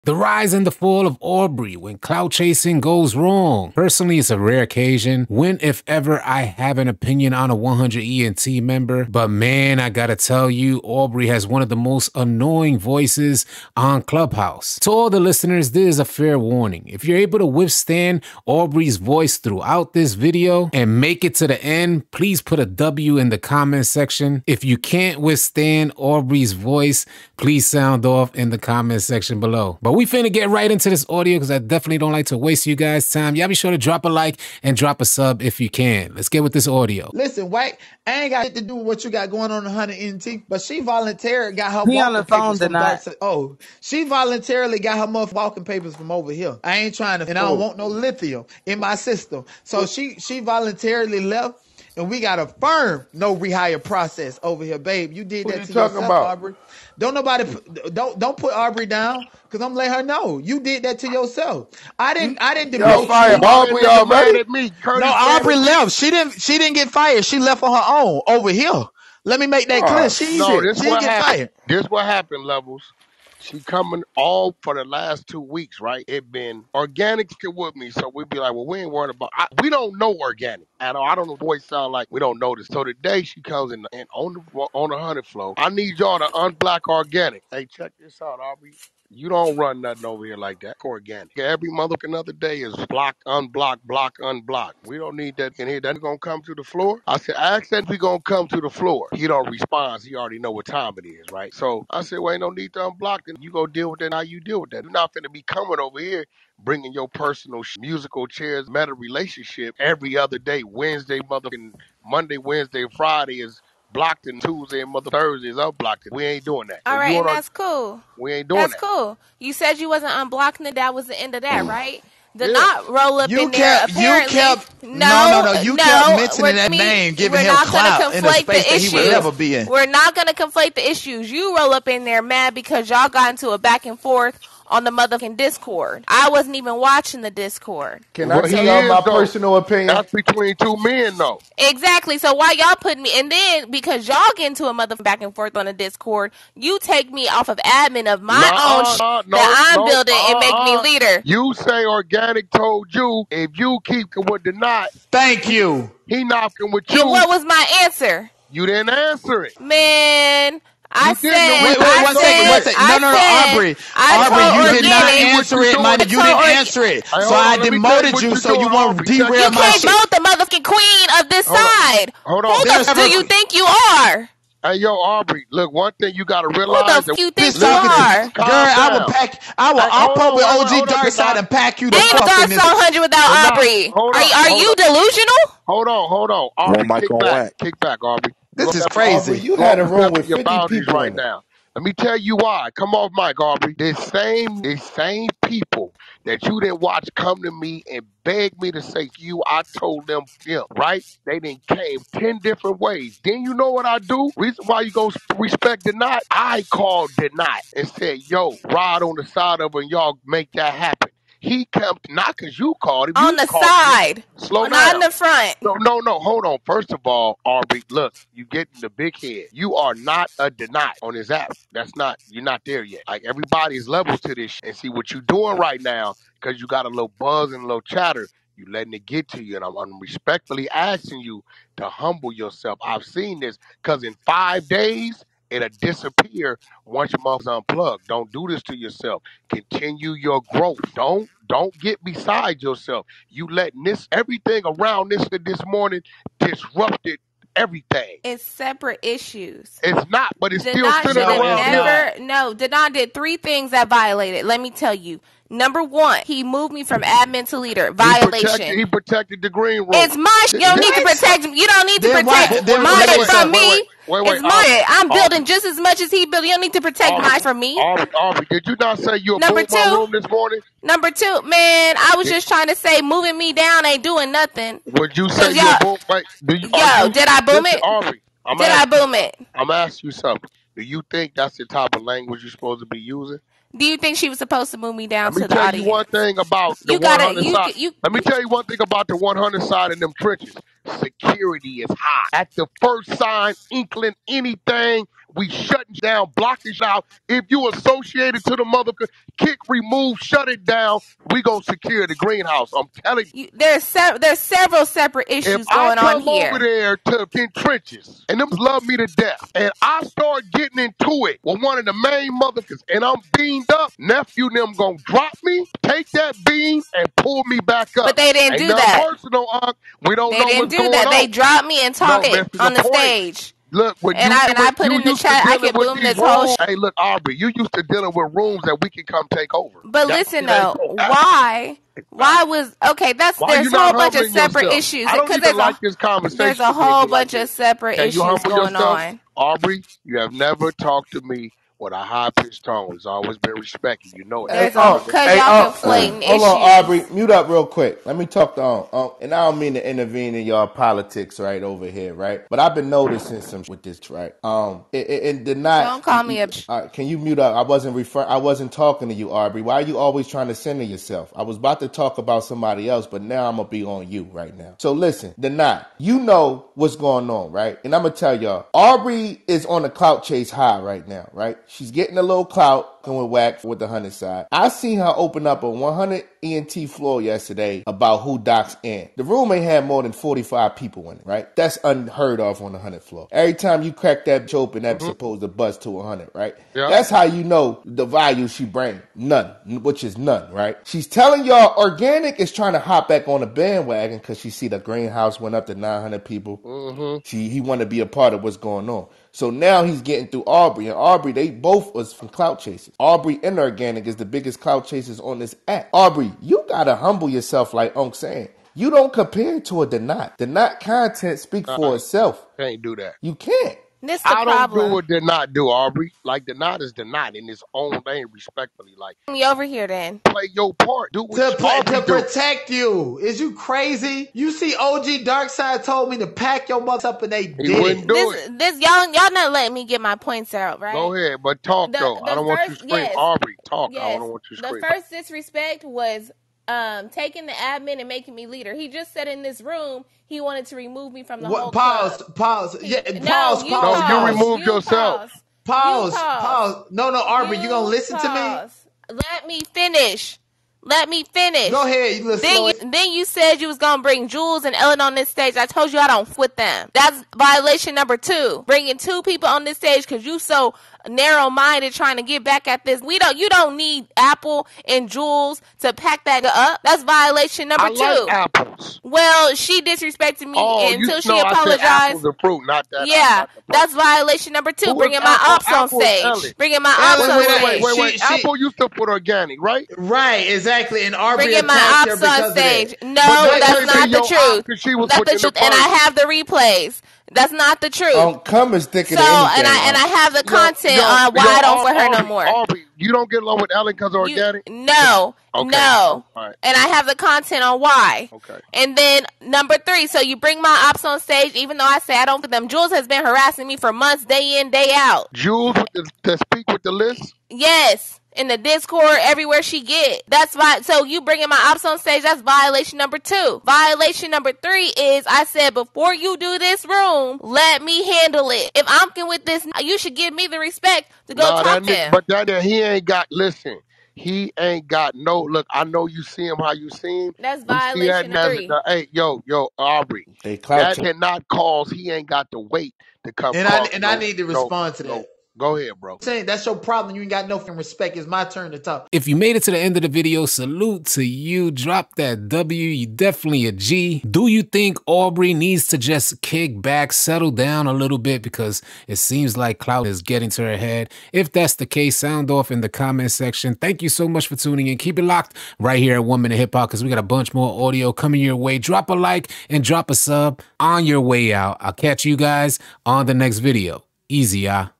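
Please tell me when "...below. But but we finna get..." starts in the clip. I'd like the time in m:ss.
0:29.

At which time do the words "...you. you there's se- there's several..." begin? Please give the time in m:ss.
5:03.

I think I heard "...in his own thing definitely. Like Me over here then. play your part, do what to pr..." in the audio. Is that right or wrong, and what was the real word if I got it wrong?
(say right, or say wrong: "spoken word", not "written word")
wrong: "respectfully", not "definitely".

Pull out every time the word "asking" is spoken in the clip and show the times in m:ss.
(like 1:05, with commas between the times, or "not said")
3:50, 4:39.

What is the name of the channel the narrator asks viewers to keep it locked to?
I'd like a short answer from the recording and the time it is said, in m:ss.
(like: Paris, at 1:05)
One Minute Hip Hop, at 9:16.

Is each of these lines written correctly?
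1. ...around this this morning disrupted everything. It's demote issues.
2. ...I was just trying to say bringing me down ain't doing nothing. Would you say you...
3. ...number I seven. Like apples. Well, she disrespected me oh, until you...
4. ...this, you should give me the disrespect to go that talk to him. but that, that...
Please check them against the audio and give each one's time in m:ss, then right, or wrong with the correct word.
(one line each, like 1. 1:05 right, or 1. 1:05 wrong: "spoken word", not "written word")
1. 4:04 wrong: "separate", not "demote"
2. 4:31 wrong: "moving", not "bringing"
3. 7:47 wrong: "two", not "seven"
4. 8:39 wrong: "respect", not "disrespect".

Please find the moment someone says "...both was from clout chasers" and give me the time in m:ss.
6:41.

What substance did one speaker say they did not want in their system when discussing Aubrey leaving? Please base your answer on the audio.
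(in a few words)
lithium.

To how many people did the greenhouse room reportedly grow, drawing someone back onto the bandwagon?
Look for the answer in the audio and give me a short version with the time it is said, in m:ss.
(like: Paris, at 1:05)
900, at 6:35.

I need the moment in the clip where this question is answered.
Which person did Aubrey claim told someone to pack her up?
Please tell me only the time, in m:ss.
7:04.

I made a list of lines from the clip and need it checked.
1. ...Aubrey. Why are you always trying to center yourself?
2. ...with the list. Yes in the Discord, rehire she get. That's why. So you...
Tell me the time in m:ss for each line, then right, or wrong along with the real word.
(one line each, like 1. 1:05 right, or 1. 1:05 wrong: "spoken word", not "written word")
1. 5:59 right
2. 8:26 wrong: "everywhere", not "rehire".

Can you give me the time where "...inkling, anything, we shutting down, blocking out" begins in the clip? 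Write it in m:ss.
4:53.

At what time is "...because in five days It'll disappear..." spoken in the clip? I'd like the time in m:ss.
3:53.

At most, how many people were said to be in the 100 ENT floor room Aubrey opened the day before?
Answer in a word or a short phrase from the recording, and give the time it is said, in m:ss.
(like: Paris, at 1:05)
45, at 6:20.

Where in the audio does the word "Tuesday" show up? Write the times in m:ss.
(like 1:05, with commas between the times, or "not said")
1:54.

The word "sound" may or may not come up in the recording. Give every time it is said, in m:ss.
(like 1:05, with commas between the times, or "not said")
0:27, 1:21, 9:12.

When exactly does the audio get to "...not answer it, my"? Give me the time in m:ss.
2:44.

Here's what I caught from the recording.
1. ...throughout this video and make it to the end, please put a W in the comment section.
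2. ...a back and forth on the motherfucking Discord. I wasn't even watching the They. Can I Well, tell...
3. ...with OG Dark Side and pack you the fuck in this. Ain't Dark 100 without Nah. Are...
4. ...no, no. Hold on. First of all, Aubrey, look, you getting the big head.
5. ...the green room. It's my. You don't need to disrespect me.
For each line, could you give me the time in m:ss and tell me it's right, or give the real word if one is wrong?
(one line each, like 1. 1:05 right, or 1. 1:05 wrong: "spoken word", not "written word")
1. 0:19 right
2. 2:13 wrong: "Discord", not "They"
3. 3:00 wrong: "Aubrey", not "Nah"
4. 3:35 right
5. 4:19 wrong: "protect", not "disrespect".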